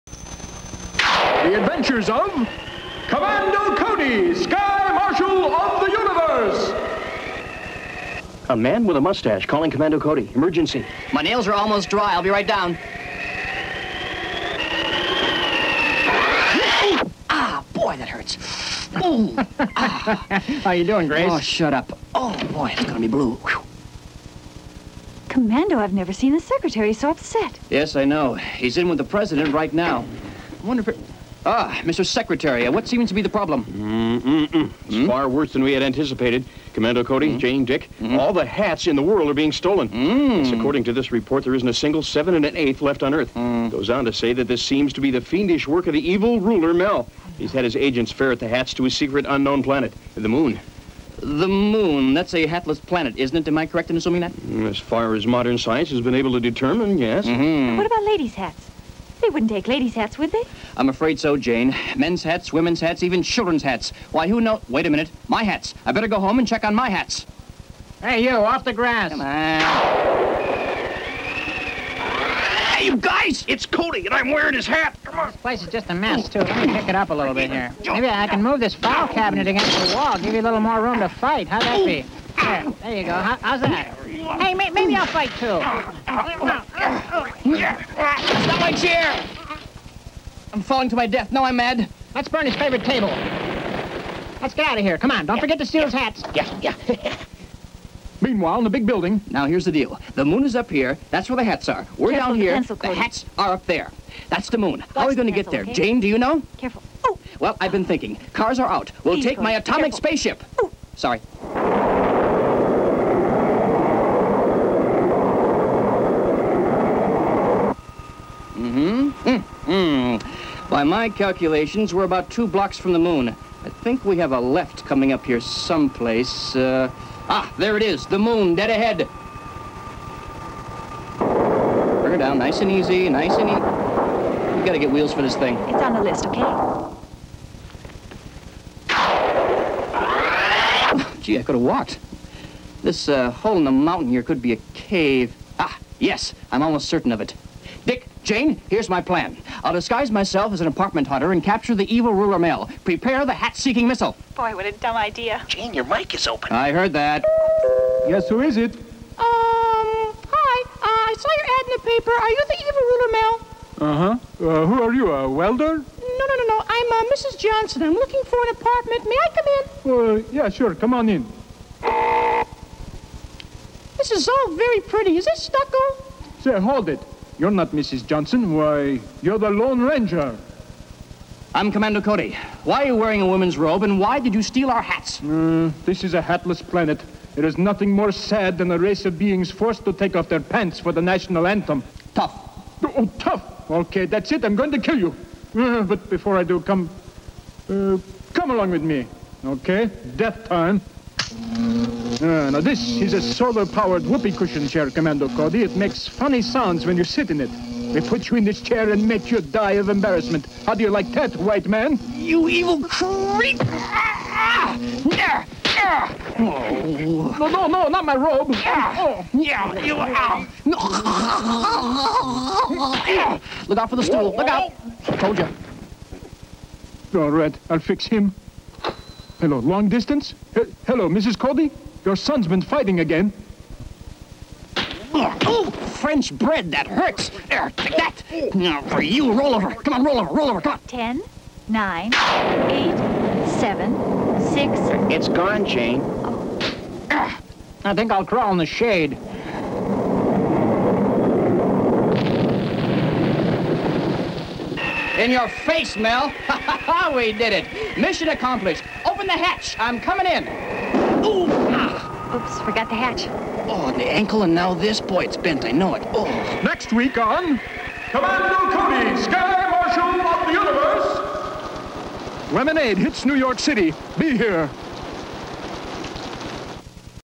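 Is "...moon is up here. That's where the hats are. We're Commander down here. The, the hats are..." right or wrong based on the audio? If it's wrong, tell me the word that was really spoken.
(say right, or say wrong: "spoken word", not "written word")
wrong: "Careful", not "Commander".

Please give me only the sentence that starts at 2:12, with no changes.
Bring her down, nice and easy, nice and easy.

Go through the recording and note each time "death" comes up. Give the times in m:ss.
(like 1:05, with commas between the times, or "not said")
1:31, 3:20.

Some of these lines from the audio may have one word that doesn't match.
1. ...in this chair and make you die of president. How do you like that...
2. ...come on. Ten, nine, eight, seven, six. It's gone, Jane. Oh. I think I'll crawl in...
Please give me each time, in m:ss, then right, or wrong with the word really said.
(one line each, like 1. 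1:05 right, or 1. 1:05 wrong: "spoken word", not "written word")
1. 3:28 wrong: "embarrassment", not "president"
2. 4:00 right.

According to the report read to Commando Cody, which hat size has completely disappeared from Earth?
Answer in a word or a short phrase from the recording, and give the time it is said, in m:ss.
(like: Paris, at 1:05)
7 1/8, at 0:42.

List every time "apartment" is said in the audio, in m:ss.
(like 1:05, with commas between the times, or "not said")
2:30, 2:48.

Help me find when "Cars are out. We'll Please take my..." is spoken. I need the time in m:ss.
1:48.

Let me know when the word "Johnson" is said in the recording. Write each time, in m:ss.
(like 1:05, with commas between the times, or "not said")
2:47, 2:58.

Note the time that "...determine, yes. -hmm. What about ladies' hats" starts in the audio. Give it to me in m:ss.
0:56.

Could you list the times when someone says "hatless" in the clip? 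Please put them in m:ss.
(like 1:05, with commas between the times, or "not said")
0:52, 3:06.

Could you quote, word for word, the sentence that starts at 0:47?
He's had his agents ferret the hats to a secret unknown planet, the moon.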